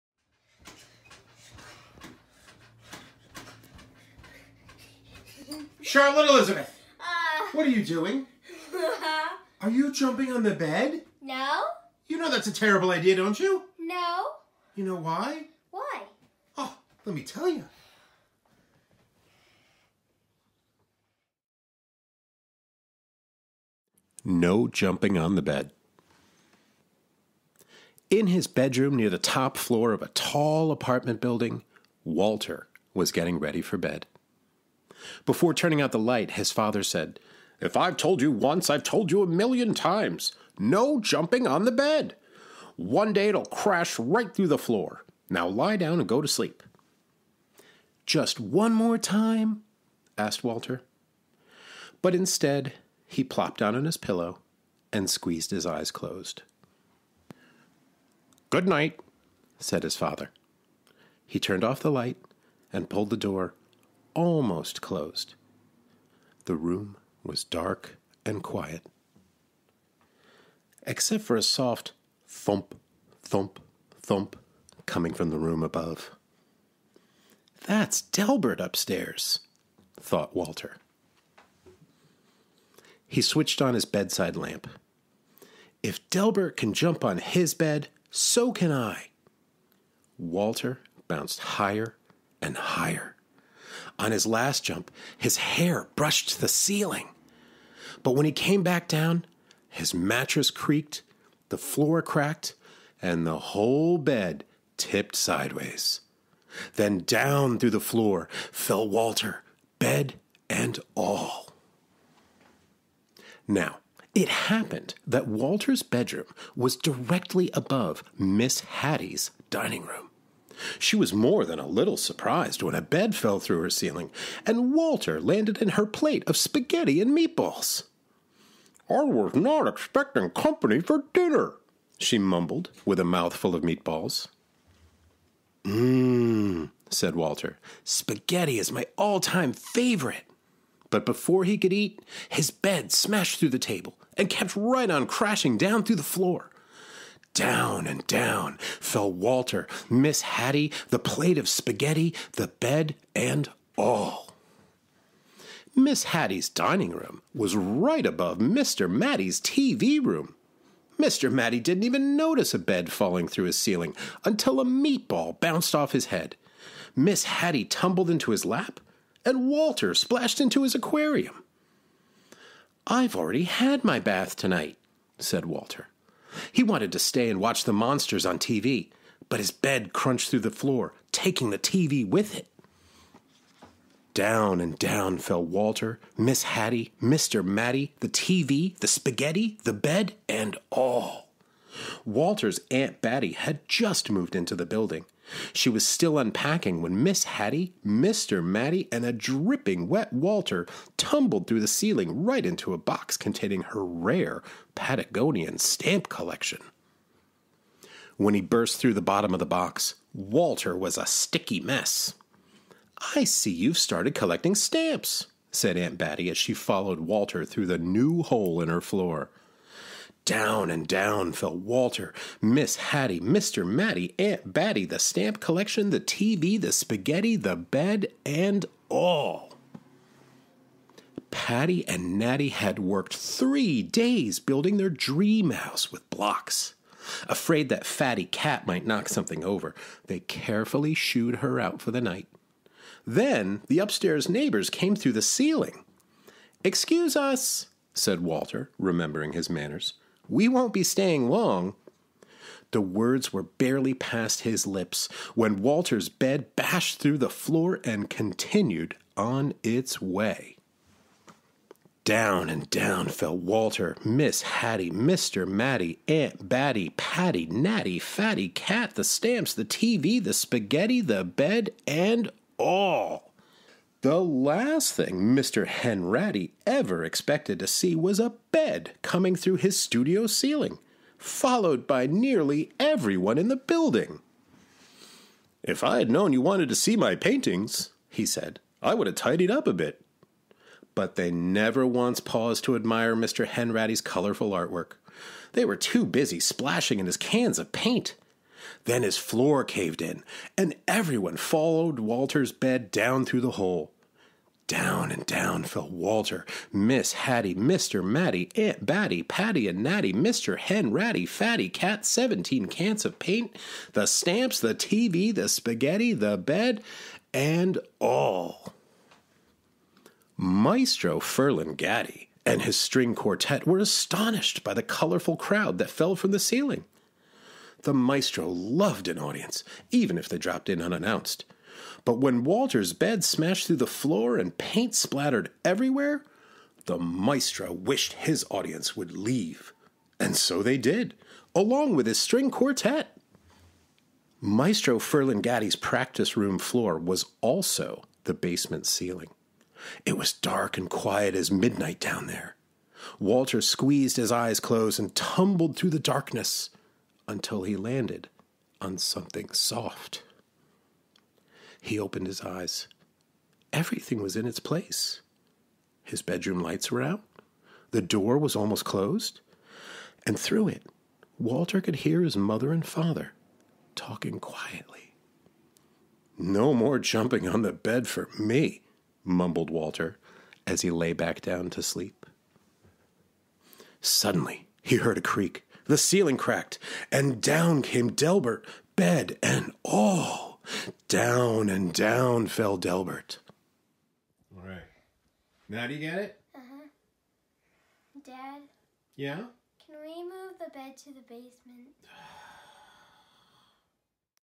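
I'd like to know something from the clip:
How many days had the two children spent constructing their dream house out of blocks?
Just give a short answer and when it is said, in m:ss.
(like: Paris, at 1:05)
3, at 3:53.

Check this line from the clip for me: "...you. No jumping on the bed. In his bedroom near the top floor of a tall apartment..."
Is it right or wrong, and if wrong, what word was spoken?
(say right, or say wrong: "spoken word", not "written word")
right.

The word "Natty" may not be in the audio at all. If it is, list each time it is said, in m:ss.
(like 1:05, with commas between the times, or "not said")
3:52, 4:27, 5:09.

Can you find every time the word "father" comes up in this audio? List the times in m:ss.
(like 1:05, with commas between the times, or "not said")
0:36, 0:59, 6:12.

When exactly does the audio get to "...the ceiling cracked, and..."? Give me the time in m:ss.
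6:25.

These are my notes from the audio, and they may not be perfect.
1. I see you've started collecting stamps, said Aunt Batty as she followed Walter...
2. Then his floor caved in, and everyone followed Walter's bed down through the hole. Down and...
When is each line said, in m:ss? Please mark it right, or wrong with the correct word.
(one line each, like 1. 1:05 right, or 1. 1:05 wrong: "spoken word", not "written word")
1. 3:33 right
2. 4:58 right.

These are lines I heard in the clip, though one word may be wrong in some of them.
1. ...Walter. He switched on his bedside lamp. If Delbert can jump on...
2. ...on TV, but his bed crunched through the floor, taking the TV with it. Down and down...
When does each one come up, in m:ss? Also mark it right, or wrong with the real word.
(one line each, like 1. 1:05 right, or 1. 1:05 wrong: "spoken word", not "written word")
1. 1:20 right
2. 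2:58 right.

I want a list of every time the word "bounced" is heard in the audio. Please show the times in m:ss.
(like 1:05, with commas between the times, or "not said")
1:31, 2:45.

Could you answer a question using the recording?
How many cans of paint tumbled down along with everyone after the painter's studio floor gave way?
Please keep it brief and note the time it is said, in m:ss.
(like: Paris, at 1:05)
17, at 5:12.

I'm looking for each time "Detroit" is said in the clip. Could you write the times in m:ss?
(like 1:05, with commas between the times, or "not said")
not said.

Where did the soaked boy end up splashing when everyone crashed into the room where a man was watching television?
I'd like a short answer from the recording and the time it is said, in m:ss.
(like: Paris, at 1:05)
his aquarium, at 2:50.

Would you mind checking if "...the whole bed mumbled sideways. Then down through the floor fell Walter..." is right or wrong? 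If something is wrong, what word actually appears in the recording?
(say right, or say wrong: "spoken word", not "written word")
wrong: "tipped", not "mumbled".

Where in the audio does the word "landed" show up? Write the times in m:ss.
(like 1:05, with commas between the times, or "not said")
2:05, 5:57.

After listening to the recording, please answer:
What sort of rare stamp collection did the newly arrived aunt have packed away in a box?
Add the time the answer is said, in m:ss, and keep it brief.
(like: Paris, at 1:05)
Patagonian, at 3:24.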